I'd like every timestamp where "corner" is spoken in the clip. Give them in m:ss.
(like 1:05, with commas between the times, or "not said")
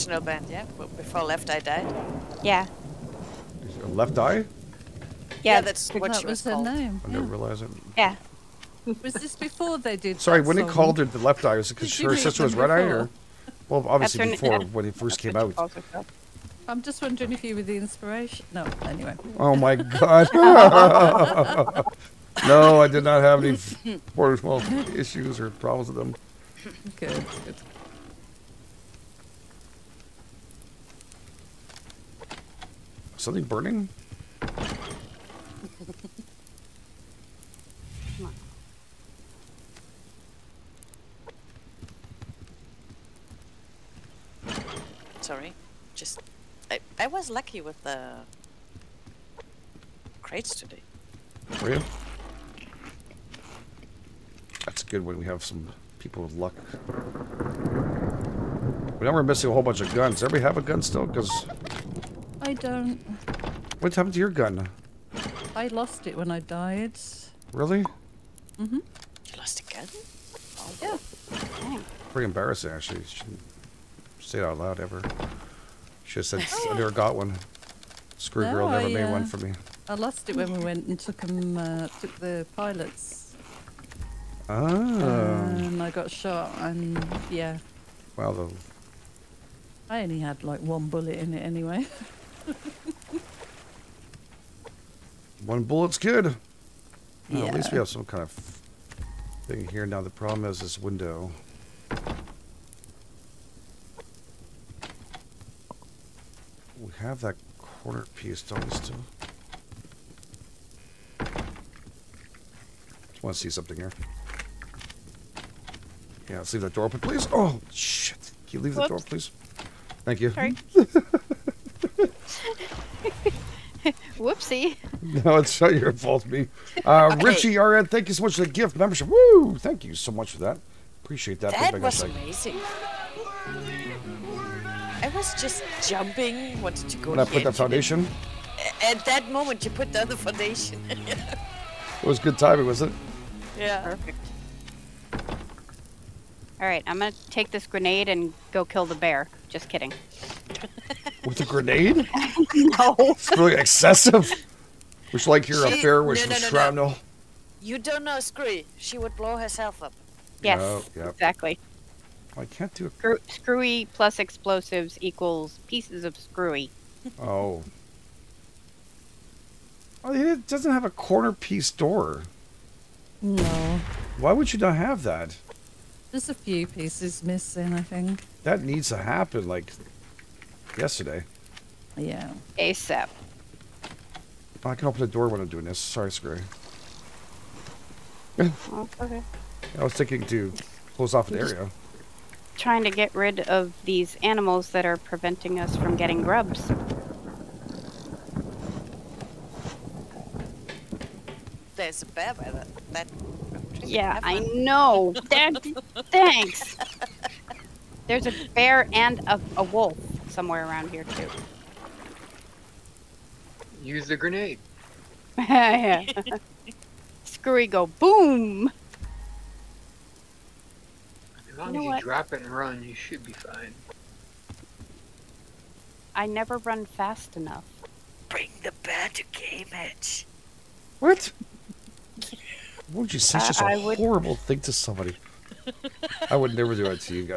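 1:47, 2:50.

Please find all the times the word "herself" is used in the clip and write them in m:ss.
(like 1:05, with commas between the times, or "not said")
2:39.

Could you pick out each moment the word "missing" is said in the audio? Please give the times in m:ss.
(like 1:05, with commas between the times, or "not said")
0:59, 2:57.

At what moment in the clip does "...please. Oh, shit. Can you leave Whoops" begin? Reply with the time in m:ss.
1:56.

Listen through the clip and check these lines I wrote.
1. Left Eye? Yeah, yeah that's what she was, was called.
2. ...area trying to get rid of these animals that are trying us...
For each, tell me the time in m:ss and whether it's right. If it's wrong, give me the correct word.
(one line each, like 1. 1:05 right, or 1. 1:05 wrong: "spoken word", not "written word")
1. 0:03 right
2. 3:11 wrong: "preventing", not "trying".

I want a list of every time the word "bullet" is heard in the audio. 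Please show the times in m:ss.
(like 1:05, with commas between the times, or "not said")
1:30, 1:35.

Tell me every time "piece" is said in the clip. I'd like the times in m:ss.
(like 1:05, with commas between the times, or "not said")
1:48, 2:45, 2:51, 2:56.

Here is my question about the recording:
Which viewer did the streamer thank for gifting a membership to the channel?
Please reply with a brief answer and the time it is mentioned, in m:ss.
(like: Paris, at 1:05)
Richie RN, at 2:07.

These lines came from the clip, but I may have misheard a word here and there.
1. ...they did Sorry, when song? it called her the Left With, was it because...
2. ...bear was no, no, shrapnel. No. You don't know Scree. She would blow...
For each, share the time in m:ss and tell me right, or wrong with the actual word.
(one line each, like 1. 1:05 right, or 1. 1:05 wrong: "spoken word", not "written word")
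1. 0:09 wrong: "Eye", not "With"
2. 2:35 right.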